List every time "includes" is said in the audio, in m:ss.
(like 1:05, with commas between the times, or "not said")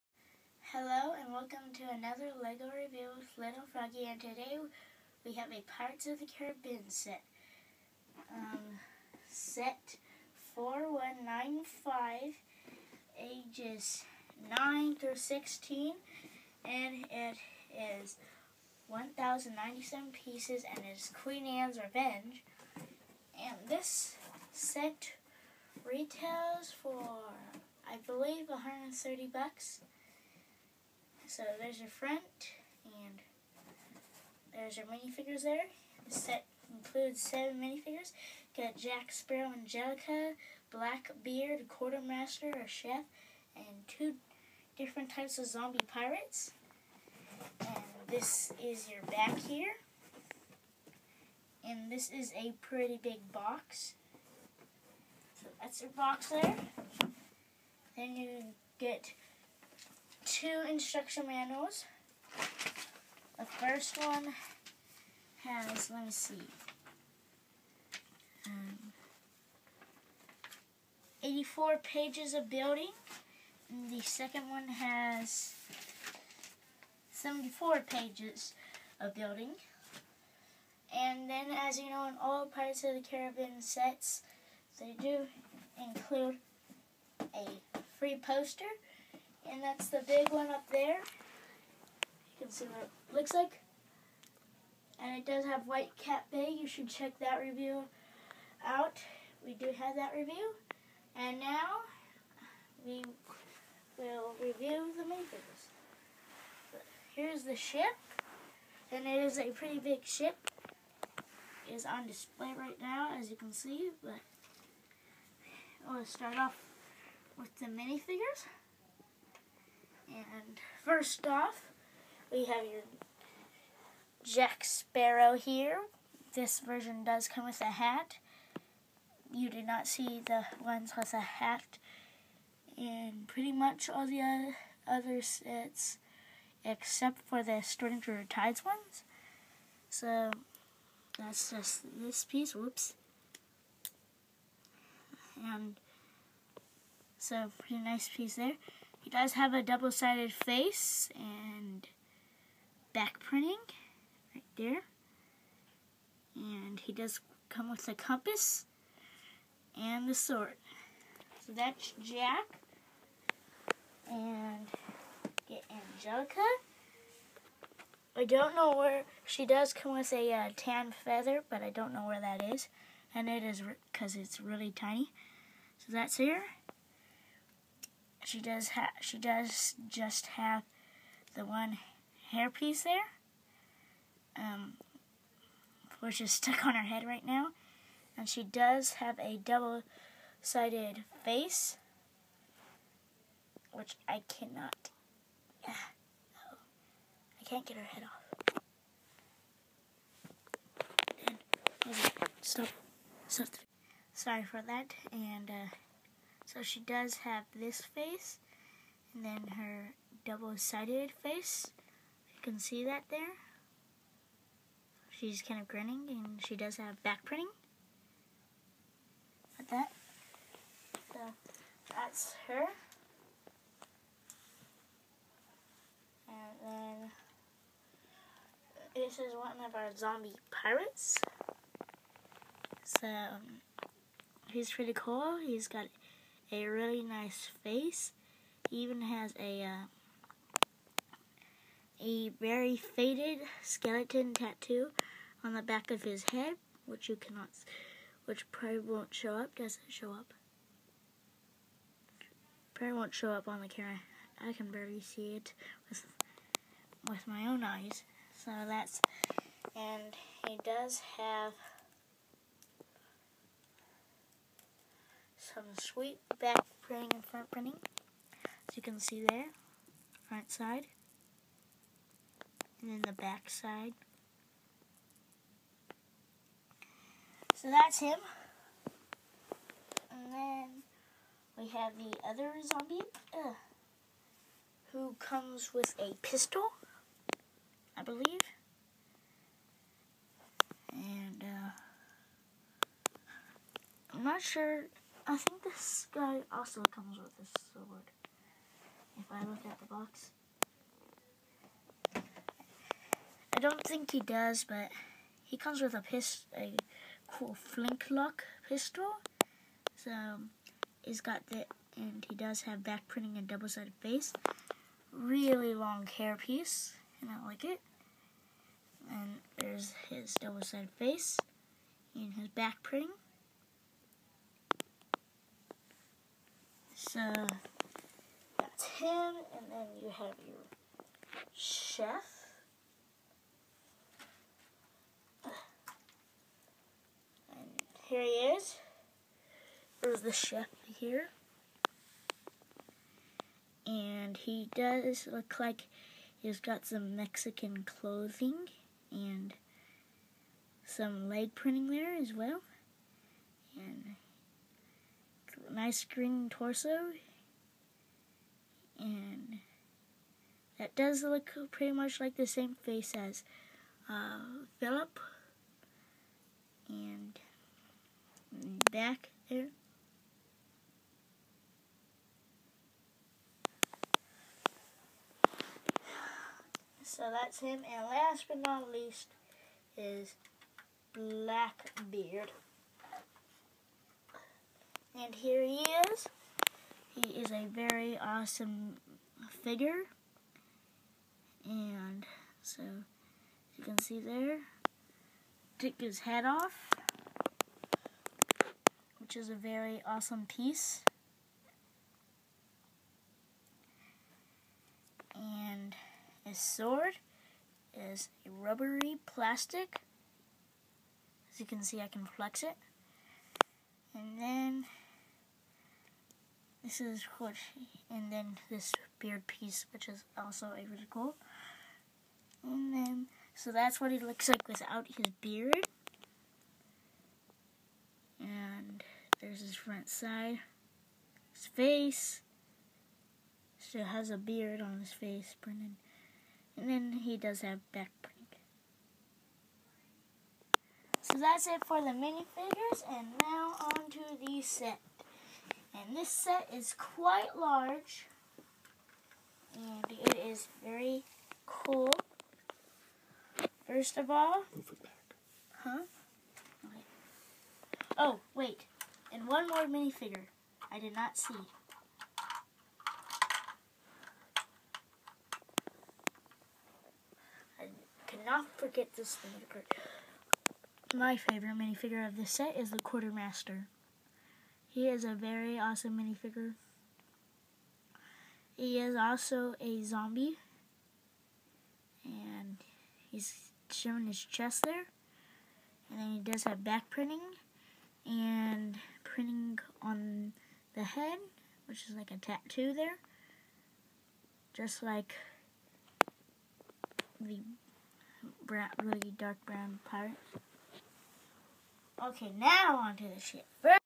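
0:36, 1:25.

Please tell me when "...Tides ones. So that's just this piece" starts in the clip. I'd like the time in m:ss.
2:18.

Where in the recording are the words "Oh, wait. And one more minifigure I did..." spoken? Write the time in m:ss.
7:38.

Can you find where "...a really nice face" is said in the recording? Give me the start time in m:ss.
3:56.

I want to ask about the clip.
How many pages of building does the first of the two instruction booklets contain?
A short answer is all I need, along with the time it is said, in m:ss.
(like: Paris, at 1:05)
84, at 1:11.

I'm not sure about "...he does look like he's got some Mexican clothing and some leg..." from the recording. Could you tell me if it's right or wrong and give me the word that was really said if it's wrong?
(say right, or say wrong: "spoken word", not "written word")
right.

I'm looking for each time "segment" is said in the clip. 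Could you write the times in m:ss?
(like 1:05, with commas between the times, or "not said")
not said.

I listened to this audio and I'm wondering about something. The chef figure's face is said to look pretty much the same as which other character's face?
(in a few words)
Philip.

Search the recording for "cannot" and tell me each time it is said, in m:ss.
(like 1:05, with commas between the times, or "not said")
3:14, 4:07, 7:48.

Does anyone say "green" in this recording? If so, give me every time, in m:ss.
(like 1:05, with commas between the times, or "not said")
5:56.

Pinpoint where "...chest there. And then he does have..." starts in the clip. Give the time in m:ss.
8:04.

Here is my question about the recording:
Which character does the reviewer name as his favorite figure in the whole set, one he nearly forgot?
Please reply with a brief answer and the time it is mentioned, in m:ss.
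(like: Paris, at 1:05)
the Quartermaster, at 7:52.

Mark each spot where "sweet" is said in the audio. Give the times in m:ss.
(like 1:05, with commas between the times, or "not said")
4:25.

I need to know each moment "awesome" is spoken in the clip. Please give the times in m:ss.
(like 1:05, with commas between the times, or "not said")
6:28, 6:40, 7:55.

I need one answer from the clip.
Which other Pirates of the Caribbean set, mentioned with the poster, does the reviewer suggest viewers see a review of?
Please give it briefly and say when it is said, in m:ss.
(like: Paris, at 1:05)
Whitecap Bay, at 1:35.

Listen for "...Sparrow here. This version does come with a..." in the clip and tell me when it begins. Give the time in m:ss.
2:04.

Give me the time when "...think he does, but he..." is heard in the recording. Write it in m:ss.
5:03.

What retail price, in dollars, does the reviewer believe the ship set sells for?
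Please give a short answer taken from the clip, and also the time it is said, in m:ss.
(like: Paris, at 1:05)
130, at 0:28.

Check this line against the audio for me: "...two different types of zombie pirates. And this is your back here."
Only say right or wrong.
right.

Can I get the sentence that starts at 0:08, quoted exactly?
Um, set 4195, ages 9 through 16 and it is 1097 pieces and is Queen Anne's Revenge.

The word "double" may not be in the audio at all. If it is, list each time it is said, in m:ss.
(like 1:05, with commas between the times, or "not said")
2:29, 3:09, 3:30, 5:13, 5:20.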